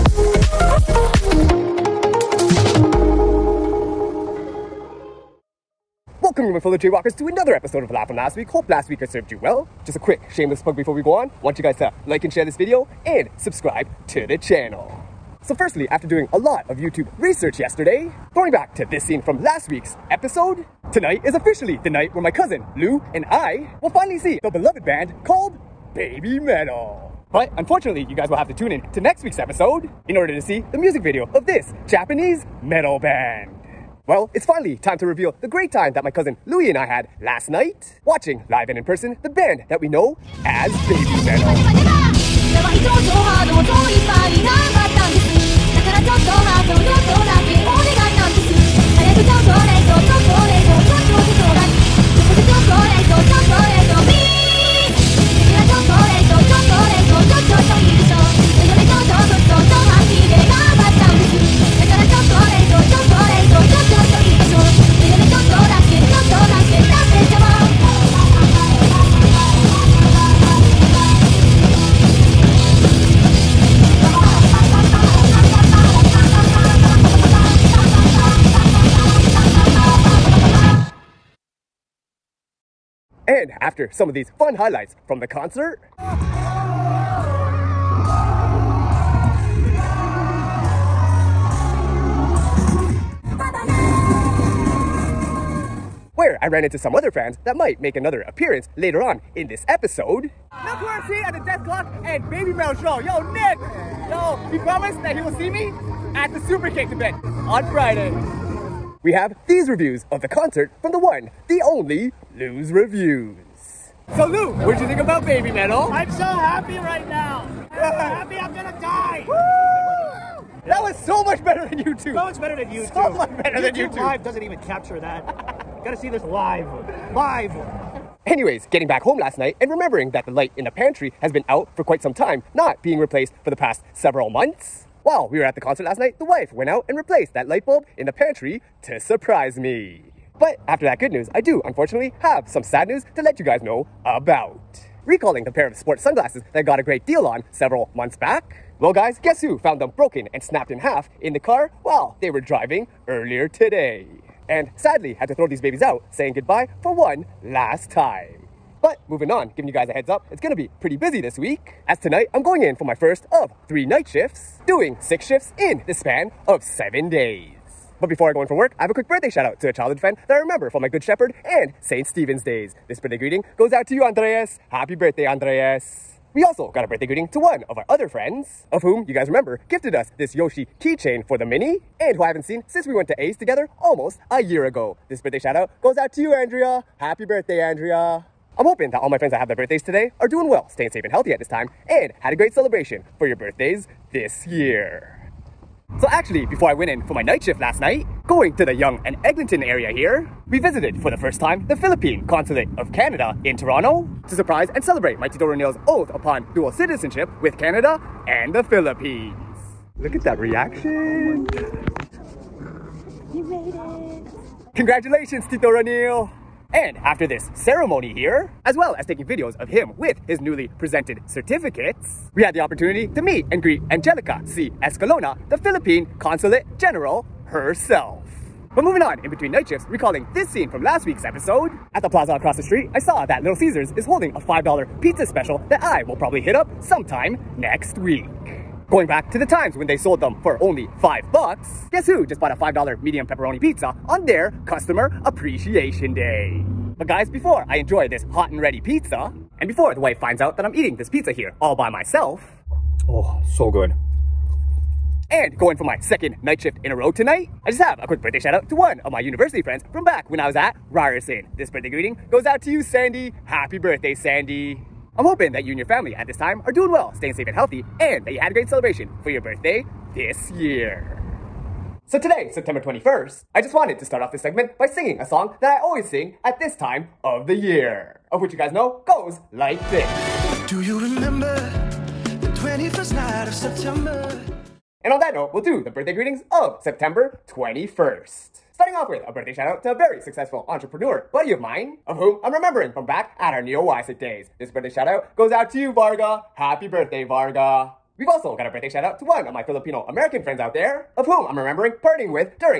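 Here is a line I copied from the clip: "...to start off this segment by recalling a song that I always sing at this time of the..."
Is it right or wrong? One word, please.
wrong.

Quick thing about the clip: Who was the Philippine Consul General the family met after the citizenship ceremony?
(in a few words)
Angelica C. Escalona.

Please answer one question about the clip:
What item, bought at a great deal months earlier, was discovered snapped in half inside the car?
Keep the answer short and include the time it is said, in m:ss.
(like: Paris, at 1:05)
sports sunglasses, at 2:25.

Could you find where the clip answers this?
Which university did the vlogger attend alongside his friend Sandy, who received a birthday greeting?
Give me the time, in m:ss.
4:20.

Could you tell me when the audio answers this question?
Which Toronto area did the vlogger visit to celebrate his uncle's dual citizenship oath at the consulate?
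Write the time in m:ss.
3:18.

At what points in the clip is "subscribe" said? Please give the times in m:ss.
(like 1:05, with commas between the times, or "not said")
0:13.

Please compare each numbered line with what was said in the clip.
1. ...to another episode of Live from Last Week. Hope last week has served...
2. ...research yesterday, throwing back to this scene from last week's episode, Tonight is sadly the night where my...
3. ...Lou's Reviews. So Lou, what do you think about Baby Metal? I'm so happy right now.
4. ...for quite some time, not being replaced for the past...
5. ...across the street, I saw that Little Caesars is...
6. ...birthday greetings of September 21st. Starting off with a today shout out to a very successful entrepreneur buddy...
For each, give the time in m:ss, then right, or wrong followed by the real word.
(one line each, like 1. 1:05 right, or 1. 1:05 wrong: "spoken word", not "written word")
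1. 0:07 right
2. 0:17 wrong: "officially", not "sadly"
3. 1:52 right
4. 2:11 right
5. 3:52 right
6. 4:45 wrong: "birthday", not "today".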